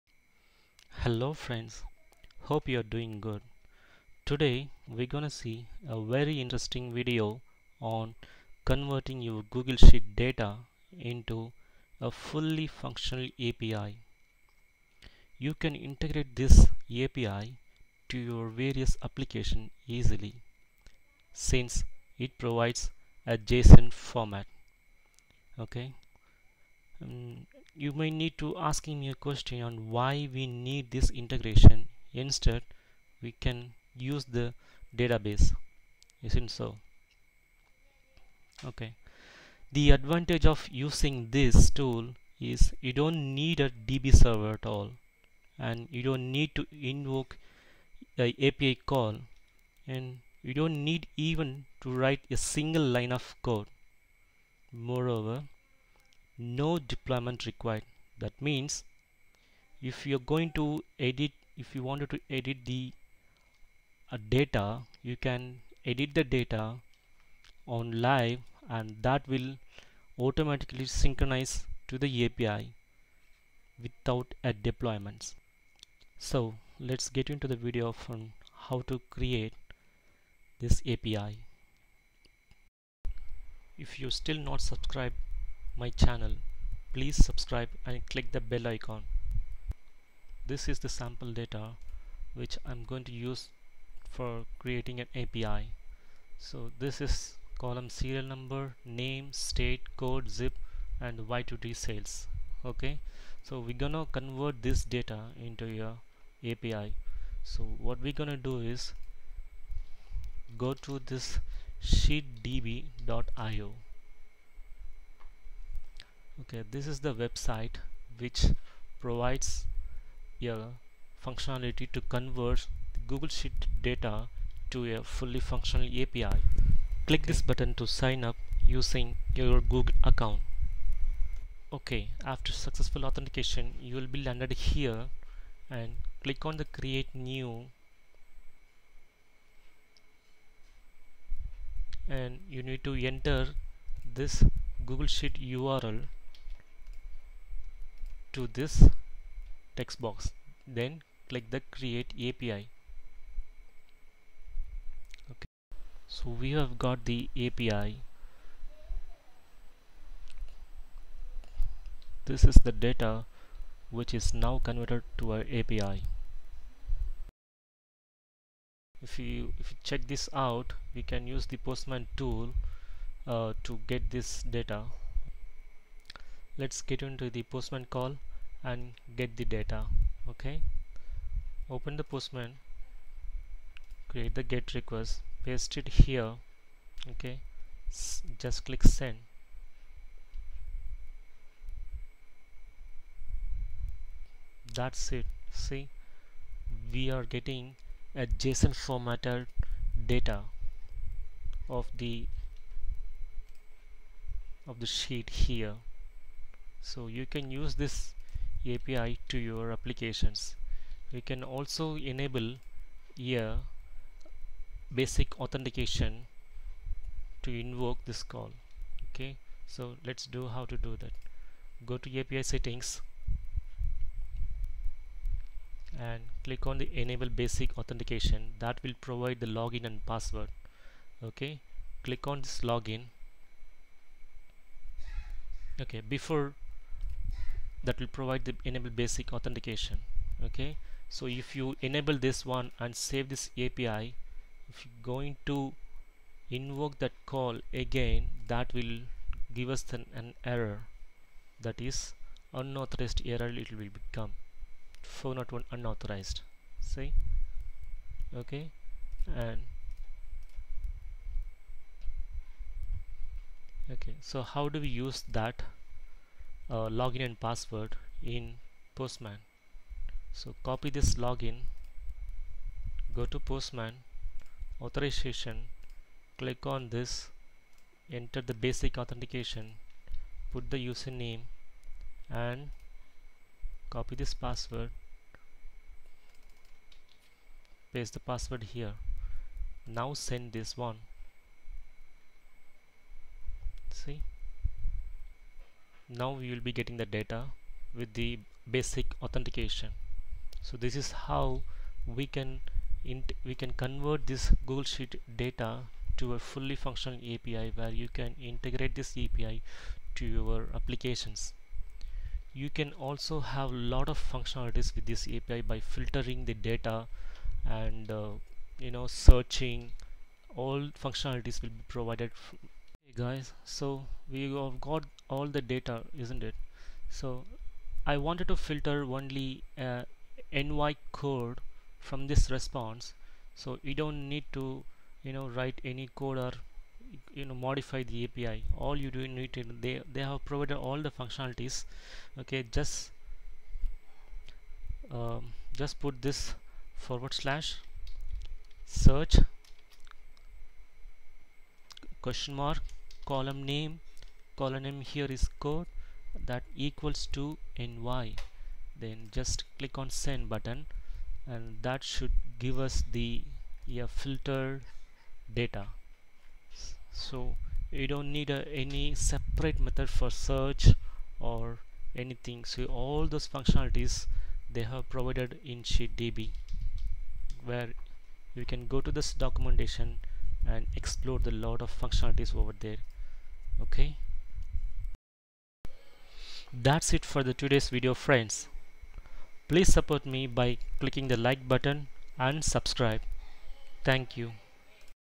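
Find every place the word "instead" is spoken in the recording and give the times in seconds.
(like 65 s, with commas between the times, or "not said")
32 s.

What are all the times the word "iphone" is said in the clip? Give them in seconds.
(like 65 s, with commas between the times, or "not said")
not said.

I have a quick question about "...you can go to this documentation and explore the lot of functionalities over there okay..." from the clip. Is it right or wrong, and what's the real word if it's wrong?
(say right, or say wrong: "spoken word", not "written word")
right.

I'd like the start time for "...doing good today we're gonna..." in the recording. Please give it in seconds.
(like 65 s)
2 s.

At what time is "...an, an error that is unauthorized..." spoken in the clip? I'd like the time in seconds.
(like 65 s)
249 s.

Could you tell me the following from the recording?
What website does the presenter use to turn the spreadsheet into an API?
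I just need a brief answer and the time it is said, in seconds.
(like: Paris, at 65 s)
sheetdb.io, at 111 s.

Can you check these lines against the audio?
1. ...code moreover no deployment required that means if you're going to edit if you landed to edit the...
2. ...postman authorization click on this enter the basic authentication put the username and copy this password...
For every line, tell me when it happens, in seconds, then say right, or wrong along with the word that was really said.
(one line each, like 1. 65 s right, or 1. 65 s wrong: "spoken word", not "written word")
1. 53 s wrong: "wanted", not "landed"
2. 273 s right.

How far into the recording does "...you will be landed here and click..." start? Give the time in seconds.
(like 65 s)
133 s.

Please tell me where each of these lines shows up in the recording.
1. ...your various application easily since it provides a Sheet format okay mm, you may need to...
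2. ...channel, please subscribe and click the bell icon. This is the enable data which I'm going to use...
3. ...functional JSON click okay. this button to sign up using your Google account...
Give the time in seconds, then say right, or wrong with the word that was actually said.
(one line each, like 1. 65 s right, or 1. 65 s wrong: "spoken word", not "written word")
1. 18 s wrong: "JSON", not "Sheet"
2. 85 s wrong: "sample", not "enable"
3. 125 s wrong: "API", not "JSON".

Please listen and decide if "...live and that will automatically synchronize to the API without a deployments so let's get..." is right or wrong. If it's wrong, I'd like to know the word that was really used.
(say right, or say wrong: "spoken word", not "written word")
right.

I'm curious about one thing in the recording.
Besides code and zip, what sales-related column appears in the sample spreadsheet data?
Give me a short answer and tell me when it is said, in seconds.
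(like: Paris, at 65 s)
Y2D sales, at 101 s.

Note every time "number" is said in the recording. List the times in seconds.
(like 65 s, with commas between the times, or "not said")
98 s.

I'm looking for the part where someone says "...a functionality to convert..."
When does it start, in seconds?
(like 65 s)
120 s.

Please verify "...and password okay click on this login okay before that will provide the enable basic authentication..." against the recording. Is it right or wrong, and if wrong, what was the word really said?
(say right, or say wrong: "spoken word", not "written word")
right.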